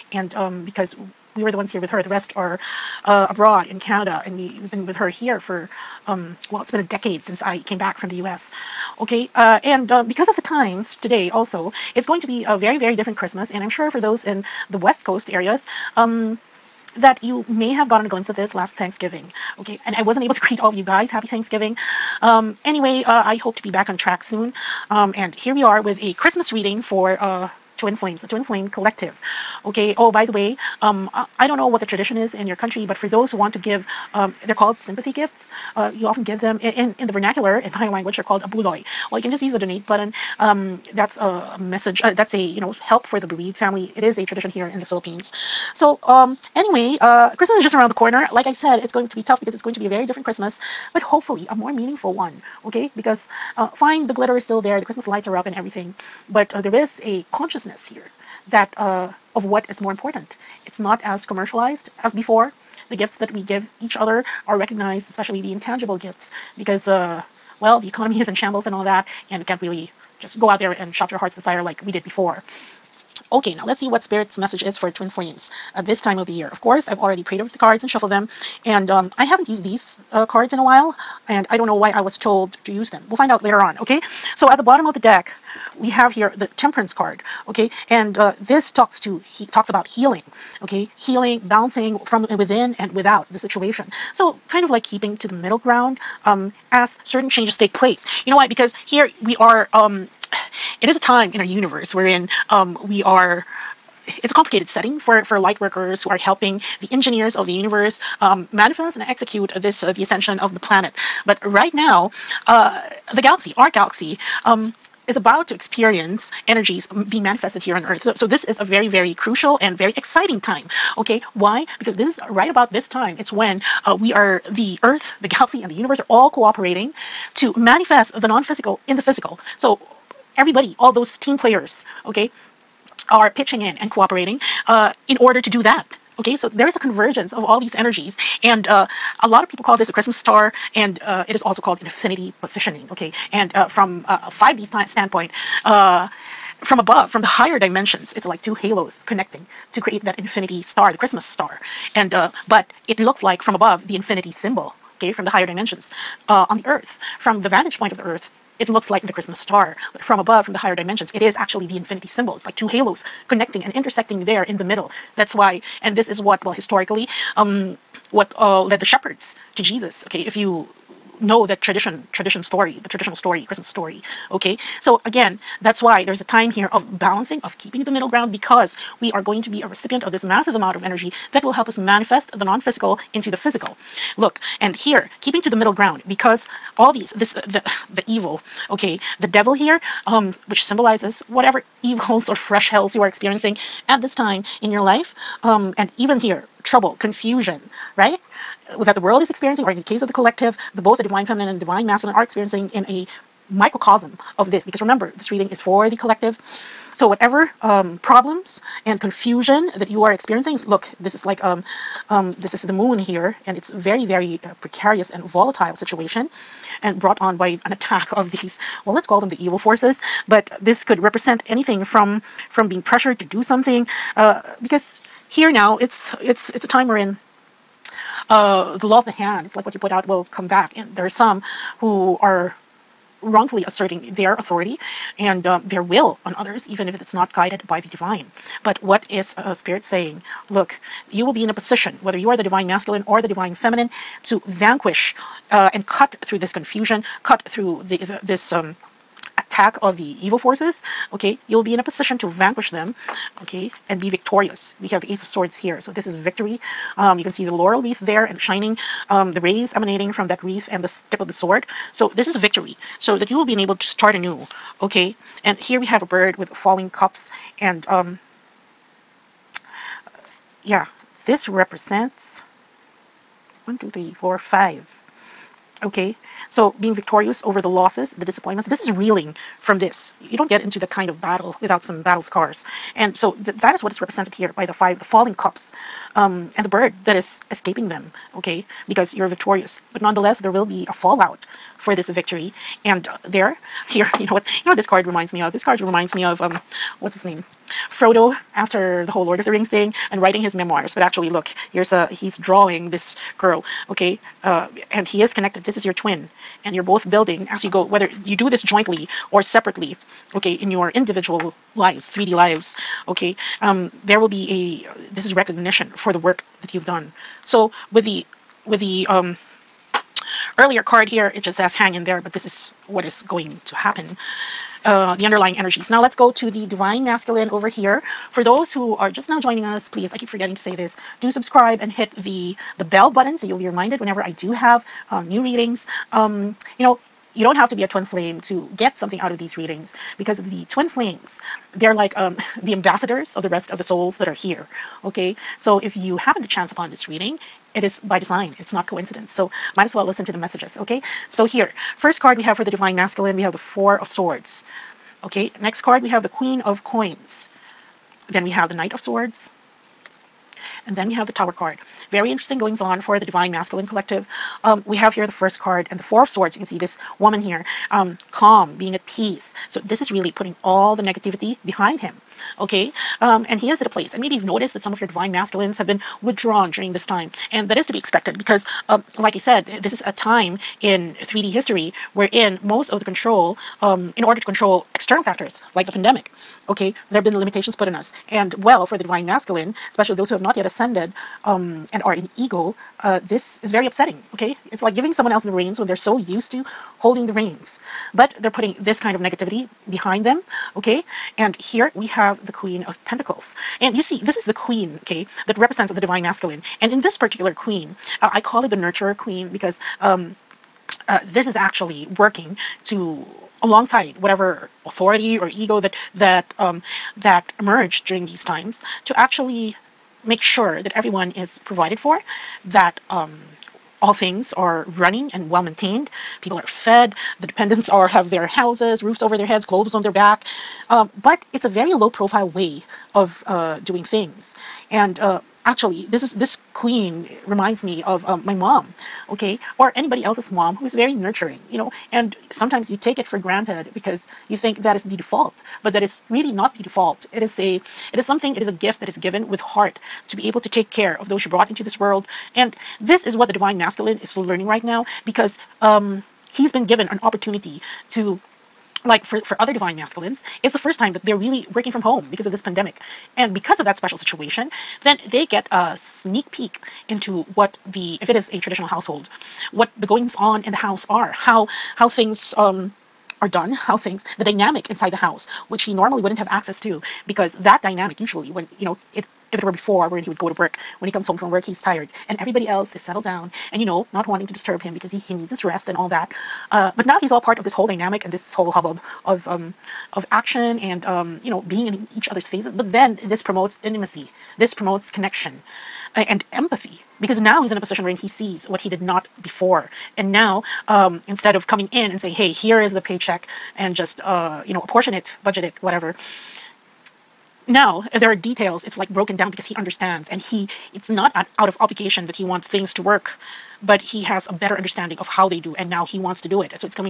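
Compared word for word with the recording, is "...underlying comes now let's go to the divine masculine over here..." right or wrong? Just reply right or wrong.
wrong.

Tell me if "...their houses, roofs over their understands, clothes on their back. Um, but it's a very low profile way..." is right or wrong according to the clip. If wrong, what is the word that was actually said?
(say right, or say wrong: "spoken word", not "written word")
wrong: "heads", not "understands".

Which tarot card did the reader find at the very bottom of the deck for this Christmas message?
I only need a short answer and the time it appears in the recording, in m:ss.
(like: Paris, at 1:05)
Temperance, at 1:26.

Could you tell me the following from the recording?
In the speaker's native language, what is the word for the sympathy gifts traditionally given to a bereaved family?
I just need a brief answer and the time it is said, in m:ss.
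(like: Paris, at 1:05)
abuloy, at 0:38.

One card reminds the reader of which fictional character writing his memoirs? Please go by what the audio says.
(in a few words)
Frodo.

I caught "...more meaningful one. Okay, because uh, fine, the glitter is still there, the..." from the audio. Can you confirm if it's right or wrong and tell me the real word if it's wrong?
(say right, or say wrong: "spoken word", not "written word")
right.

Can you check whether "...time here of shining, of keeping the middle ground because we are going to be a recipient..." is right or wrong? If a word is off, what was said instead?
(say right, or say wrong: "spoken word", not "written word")
wrong: "balancing", not "shining".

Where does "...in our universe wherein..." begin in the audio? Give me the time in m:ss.
1:41.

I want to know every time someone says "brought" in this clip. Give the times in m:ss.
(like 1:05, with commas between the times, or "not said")
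3:36, 7:31.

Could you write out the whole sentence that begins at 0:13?
And I'm sure for those in the West Coast areas, um, that you may have gotten a glimpse of this last Thanksgiving.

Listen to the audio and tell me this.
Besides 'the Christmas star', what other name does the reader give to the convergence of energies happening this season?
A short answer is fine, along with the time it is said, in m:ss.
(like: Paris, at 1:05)
infinity positioning, at 2:21.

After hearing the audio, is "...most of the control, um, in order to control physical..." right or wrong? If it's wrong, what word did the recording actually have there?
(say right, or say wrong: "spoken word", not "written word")
wrong: "external", not "physical".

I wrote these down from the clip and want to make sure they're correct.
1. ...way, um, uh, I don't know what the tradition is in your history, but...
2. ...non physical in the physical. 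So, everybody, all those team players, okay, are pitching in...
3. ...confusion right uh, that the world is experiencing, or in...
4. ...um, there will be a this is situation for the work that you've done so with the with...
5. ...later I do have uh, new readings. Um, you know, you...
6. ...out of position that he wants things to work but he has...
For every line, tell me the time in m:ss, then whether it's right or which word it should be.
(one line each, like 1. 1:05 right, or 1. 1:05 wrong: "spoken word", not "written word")
1. 0:30 wrong: "country", not "history"
2. 2:08 right
3. 3:17 right
4. 5:13 wrong: "recognition", not "situation"
5. 5:33 wrong: "whenever", not "later"
6. 8:31 wrong: "obligation", not "position".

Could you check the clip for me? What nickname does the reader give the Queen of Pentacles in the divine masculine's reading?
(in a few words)
Nurturer Queen.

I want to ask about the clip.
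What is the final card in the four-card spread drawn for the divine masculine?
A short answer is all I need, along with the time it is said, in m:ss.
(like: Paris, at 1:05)
The Tower, at 6:01.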